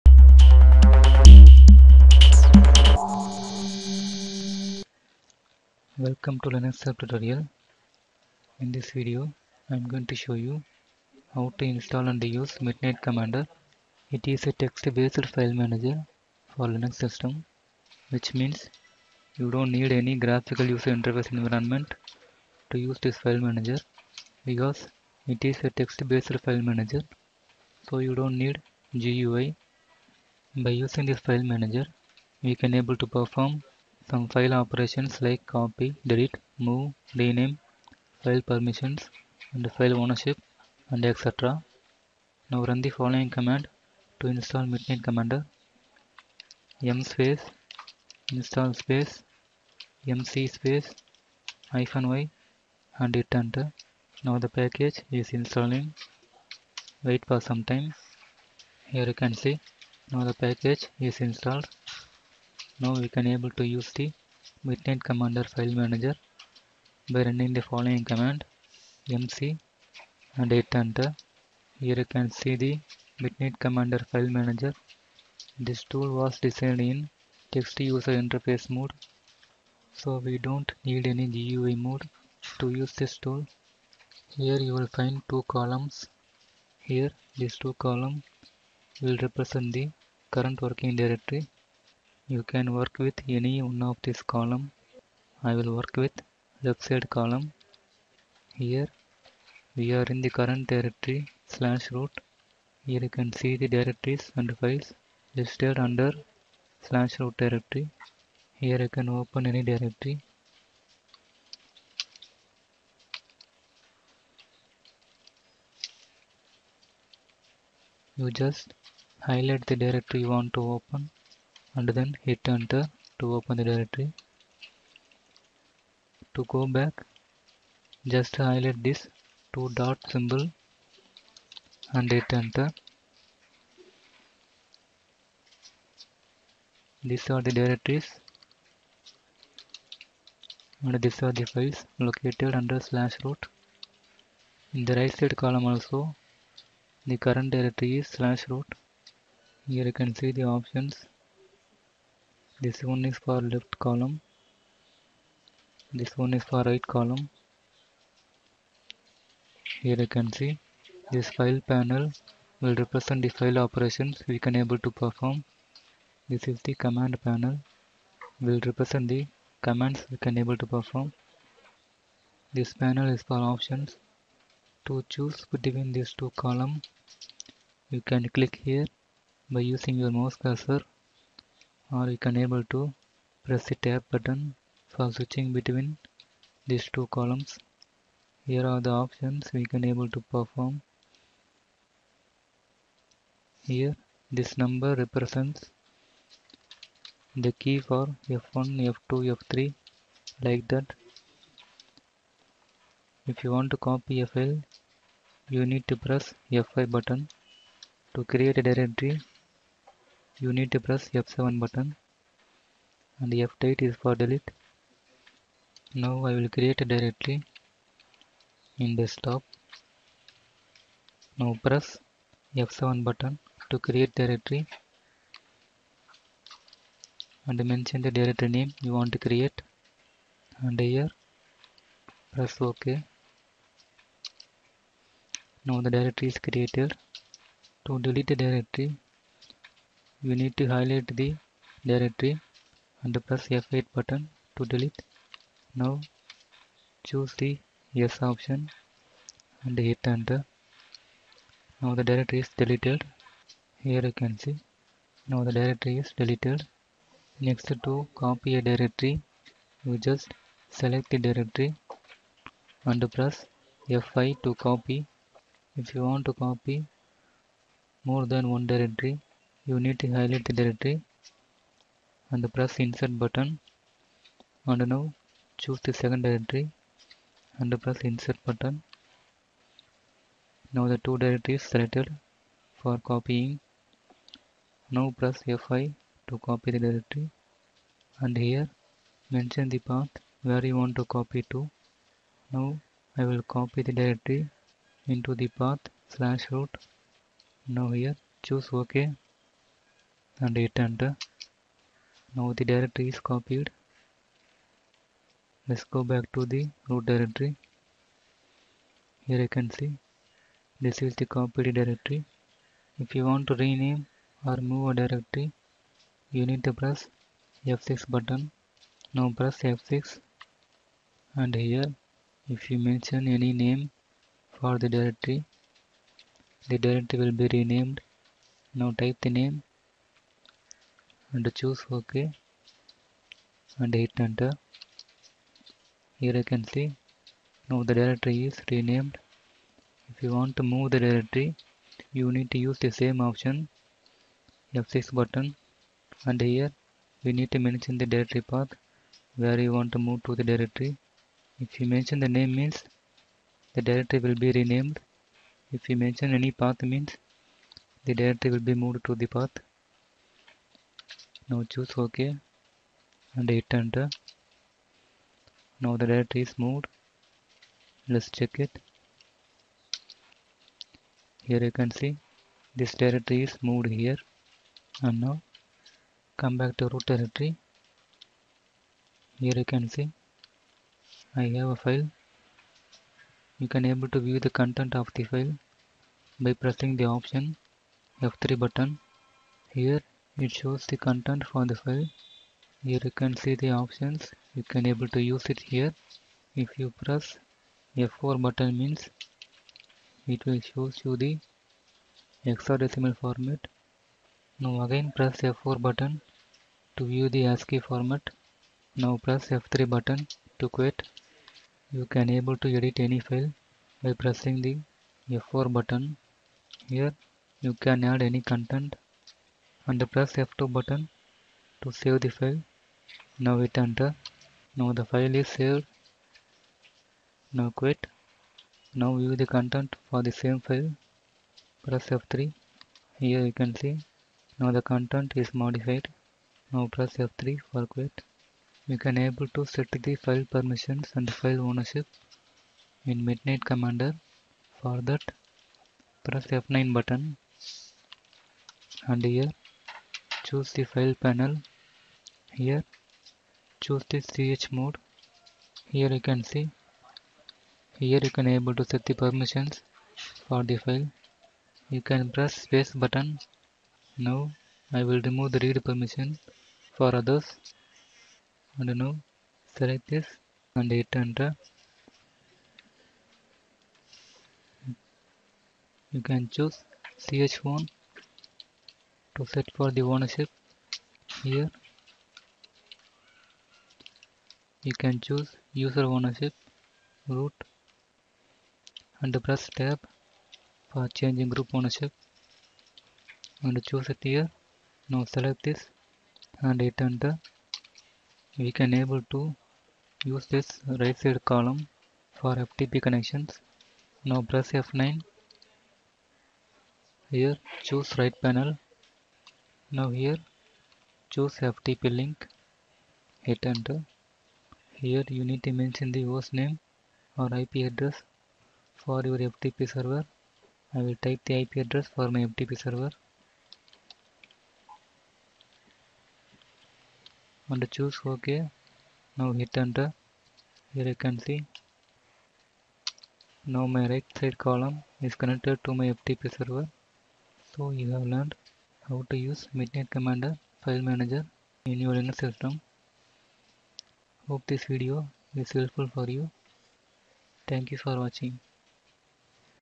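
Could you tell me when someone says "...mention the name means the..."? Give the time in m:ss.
5:51.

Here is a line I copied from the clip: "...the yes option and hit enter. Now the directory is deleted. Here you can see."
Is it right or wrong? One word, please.
right.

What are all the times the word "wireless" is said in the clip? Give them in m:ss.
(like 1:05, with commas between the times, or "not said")
not said.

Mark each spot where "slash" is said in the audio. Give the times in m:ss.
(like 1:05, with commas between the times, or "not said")
1:41, 1:46, 2:22, 2:28, 4:56.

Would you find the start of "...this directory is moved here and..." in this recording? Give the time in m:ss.
6:12.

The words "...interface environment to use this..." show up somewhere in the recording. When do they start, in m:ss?
0:20.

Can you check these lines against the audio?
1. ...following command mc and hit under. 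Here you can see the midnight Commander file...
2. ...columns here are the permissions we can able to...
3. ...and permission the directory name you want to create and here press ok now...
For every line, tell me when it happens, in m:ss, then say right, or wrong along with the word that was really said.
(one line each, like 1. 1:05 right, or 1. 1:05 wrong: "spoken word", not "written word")
1. 1:07 wrong: "enter", not "under"
2. 3:07 wrong: "options", not "permissions"
3. 3:47 wrong: "mention", not "permission".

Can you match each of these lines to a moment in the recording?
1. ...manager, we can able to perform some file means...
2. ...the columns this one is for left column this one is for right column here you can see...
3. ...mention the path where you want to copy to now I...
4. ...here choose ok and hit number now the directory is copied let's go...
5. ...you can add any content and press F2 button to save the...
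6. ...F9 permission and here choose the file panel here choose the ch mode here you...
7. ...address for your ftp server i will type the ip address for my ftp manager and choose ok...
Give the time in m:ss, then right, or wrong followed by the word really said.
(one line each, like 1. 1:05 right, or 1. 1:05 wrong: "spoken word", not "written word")
1. 0:31 wrong: "operations", not "means"
2. 2:30 wrong: "options", not "columns"
3. 4:49 right
4. 4:57 wrong: "enter", not "number"
5. 6:57 right
6. 7:26 wrong: "button", not "permission"
7. 8:37 wrong: "server", not "manager".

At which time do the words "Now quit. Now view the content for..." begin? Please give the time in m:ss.
7:07.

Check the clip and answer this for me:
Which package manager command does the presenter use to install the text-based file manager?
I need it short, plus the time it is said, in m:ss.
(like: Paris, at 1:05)
yum, at 0:46.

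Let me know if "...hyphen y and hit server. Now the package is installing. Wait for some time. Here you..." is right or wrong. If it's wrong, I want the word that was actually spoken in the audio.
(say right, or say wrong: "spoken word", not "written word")
wrong: "enter", not "server".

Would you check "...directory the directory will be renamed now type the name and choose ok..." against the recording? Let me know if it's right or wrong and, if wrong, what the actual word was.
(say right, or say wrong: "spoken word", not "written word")
right.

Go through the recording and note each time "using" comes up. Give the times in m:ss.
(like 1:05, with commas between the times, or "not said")
0:30, 2:59.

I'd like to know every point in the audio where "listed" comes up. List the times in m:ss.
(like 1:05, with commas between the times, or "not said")
1:45.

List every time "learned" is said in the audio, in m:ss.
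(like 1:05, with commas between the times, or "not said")
8:58.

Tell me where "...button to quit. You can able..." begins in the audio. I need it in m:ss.
6:49.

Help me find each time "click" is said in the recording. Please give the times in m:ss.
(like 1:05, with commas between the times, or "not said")
2:58.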